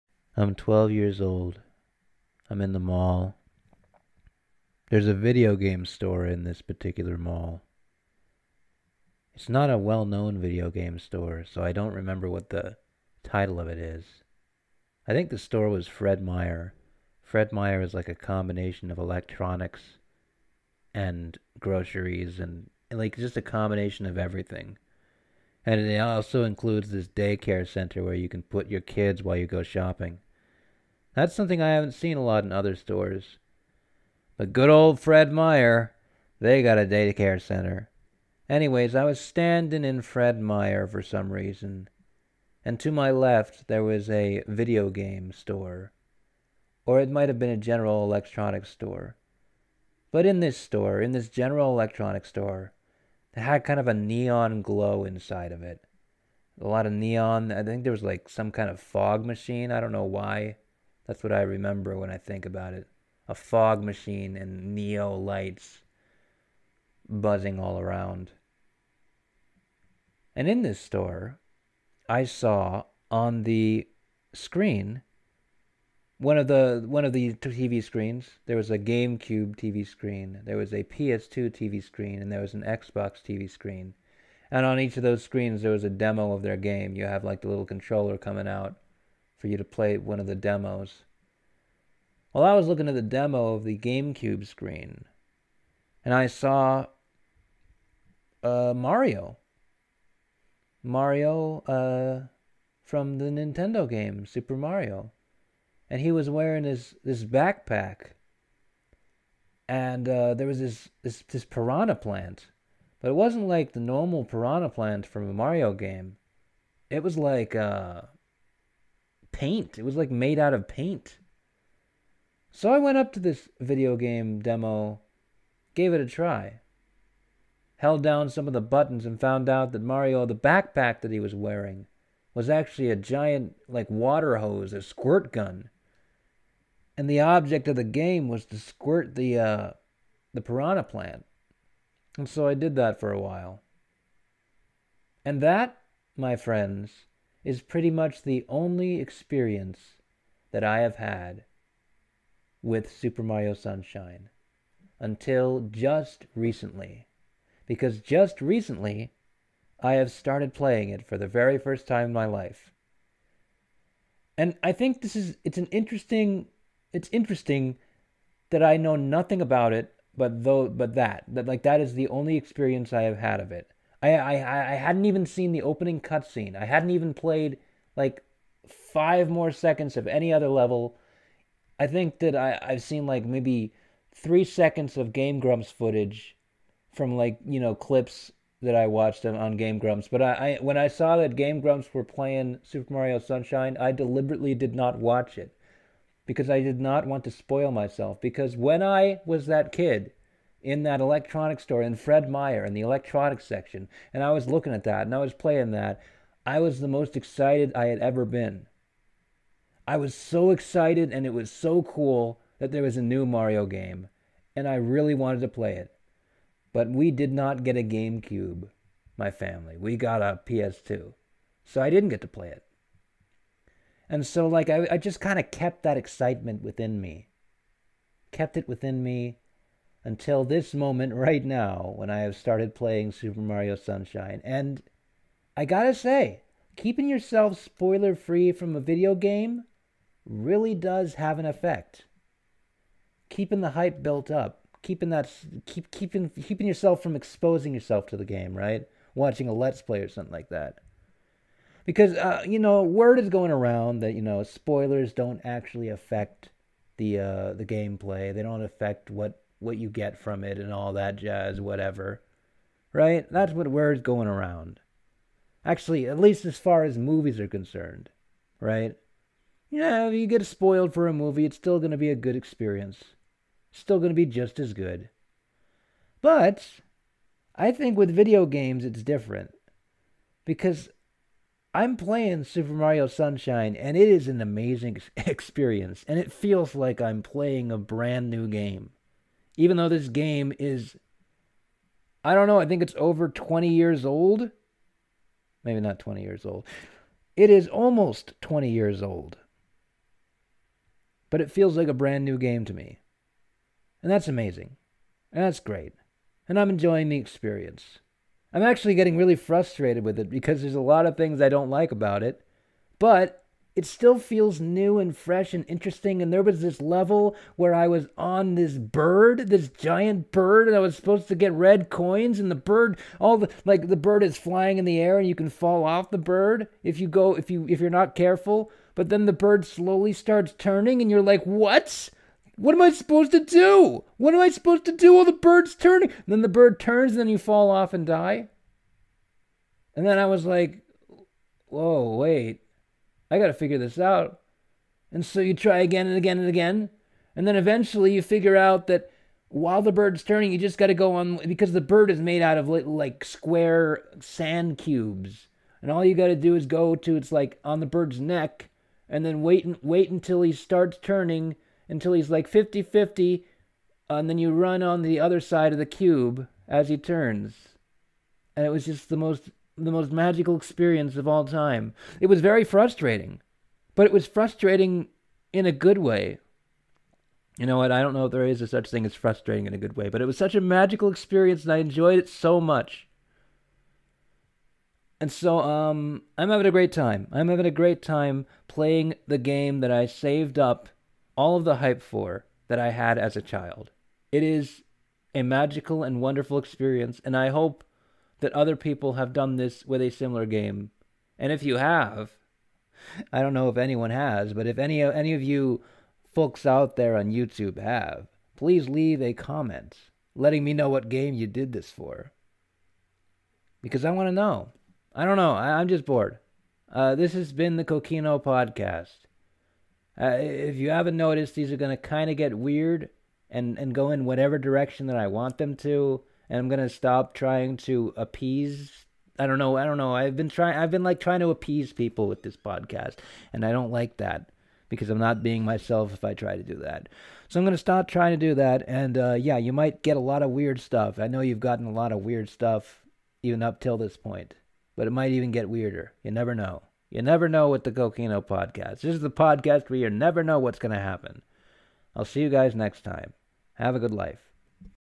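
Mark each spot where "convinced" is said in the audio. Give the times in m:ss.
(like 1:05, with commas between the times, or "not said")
not said.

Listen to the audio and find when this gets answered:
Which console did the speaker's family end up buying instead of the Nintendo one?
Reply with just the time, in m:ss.
3:39.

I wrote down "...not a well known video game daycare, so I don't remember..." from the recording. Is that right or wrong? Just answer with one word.
wrong.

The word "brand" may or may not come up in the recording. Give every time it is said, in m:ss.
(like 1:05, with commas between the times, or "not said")
4:47, 5:01.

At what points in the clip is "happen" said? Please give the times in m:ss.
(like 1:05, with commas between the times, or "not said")
7:30.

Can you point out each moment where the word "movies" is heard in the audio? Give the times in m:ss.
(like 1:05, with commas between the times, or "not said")
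4:26, 4:31.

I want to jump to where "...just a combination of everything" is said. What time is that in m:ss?
0:23.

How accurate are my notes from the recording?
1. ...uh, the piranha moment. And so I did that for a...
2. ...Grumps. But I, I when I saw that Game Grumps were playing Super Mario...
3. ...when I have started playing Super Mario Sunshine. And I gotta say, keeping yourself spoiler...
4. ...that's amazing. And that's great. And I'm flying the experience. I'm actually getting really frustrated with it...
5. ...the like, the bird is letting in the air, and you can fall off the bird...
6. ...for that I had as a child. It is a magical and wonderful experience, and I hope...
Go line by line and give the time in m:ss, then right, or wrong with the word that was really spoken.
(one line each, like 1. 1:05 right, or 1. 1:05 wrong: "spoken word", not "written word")
1. 2:19 wrong: "plant", not "moment"
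2. 3:09 right
3. 3:51 right
4. 5:04 wrong: "enjoying", not "flying"
5. 5:23 wrong: "flying", not "letting"
6. 6:32 right.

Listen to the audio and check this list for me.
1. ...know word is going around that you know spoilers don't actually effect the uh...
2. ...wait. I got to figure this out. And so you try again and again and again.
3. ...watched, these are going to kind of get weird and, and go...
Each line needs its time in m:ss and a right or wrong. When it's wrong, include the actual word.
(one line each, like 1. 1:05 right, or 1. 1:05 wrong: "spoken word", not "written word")
1. 4:12 wrong: "affect", not "effect"
2. 5:42 right
3. 7:01 wrong: "noticed", not "watched".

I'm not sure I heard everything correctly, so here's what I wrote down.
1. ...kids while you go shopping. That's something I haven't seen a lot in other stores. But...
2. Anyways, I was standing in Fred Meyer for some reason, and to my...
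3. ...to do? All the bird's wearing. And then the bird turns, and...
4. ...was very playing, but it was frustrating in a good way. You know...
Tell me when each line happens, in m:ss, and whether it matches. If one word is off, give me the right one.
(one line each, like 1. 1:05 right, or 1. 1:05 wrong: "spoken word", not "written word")
1. 0:28 right
2. 0:38 right
3. 5:34 wrong: "turning", not "wearing"
4. 6:12 wrong: "frustrating", not "playing".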